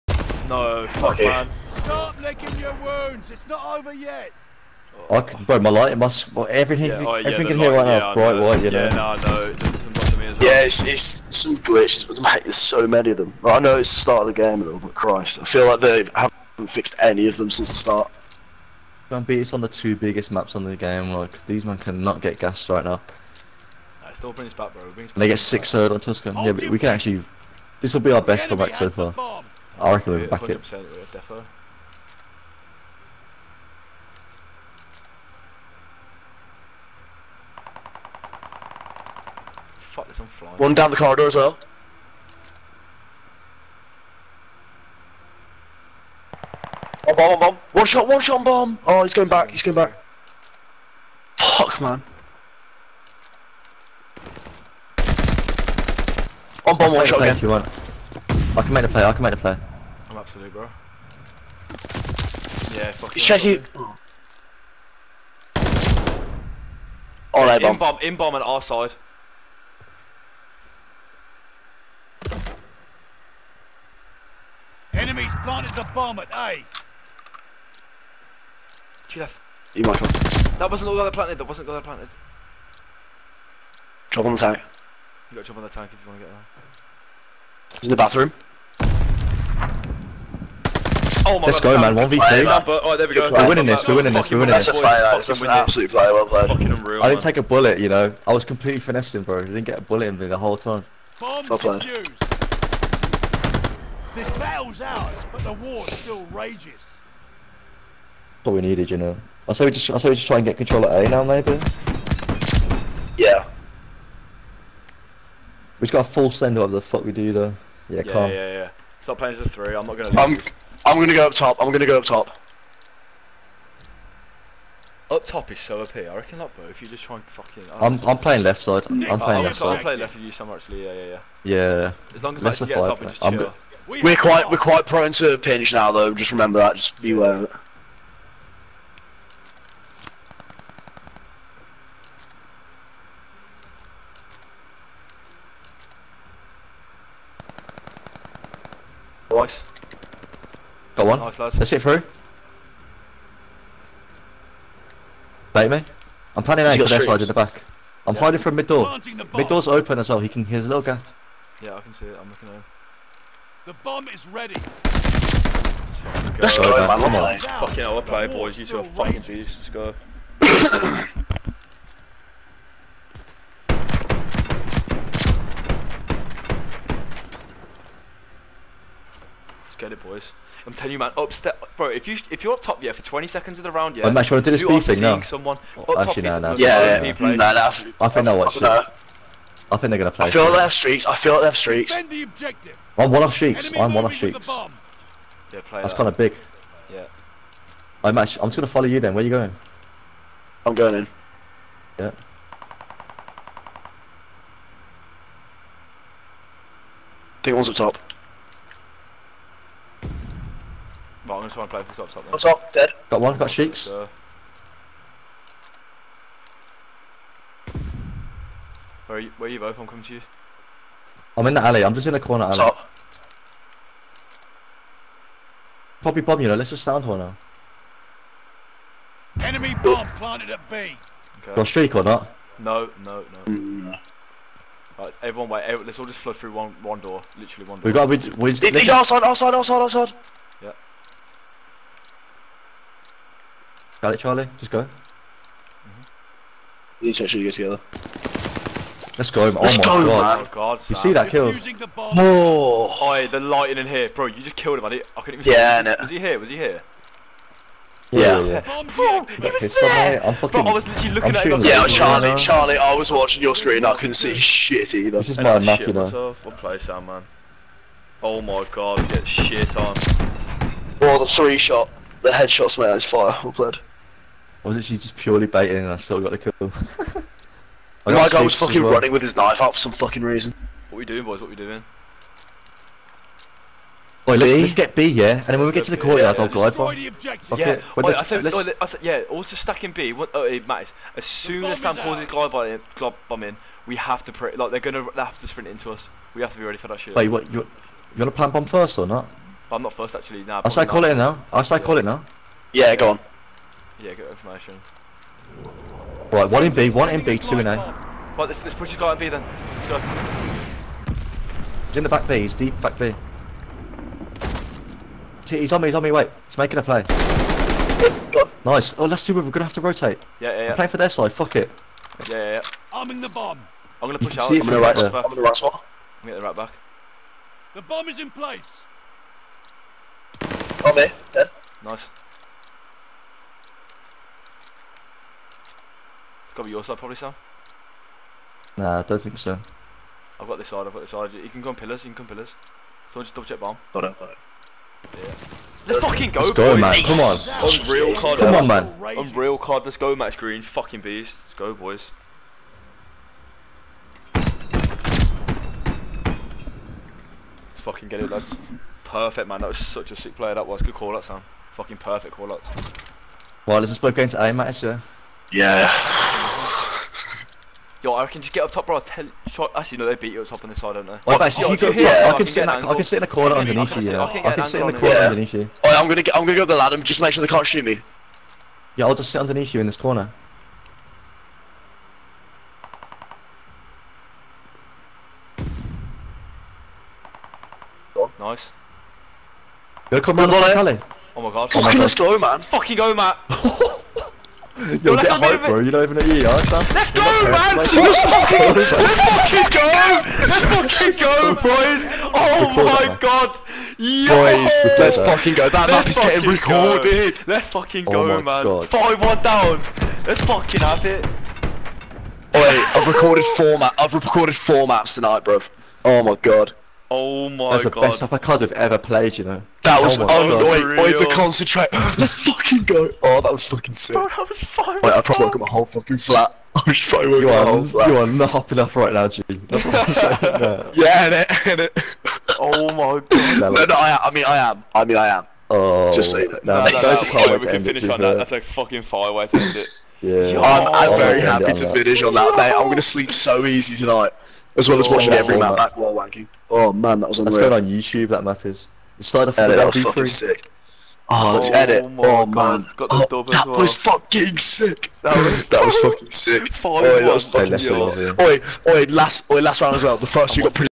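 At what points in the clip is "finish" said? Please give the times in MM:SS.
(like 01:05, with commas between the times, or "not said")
07:17, 07:21.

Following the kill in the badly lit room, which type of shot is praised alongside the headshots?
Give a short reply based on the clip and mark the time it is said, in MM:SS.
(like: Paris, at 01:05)
Three shot, at 04:31.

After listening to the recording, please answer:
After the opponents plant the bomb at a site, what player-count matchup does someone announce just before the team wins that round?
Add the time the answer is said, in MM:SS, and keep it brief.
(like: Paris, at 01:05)
1 v 3, at 01:31.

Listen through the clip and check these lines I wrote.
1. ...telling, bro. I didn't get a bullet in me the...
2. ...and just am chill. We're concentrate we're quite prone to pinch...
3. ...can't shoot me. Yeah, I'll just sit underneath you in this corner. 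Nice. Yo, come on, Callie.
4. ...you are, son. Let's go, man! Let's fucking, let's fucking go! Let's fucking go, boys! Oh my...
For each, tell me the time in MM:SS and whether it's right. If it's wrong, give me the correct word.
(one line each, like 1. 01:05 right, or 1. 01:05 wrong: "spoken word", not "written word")
1. 01:38 wrong: "finessing", not "telling"
2. 02:13 wrong: "quite", not "concentrate"
3. 06:17 right
4. 06:36 right.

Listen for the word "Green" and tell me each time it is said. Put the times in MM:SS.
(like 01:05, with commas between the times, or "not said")
05:50.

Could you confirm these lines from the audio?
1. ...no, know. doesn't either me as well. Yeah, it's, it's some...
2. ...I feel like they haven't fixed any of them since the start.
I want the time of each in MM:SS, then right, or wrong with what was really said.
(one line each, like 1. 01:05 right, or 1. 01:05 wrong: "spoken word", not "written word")
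1. 00:09 wrong: "bother", not "either"
2. 00:15 right.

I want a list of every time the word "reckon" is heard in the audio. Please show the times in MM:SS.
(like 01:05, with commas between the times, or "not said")
00:29, 02:06.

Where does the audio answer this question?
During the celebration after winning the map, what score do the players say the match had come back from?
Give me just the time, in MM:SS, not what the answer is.
06:48.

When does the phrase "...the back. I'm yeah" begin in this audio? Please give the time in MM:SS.
02:37.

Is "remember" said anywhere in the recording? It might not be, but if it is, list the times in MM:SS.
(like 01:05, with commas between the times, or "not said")
02:16.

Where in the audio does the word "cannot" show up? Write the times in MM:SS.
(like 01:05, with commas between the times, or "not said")
00:21.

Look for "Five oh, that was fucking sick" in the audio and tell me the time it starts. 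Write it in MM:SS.
07:36.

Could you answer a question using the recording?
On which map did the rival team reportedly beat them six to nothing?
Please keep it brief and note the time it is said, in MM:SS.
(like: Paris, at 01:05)
Tuscan, at 00:26.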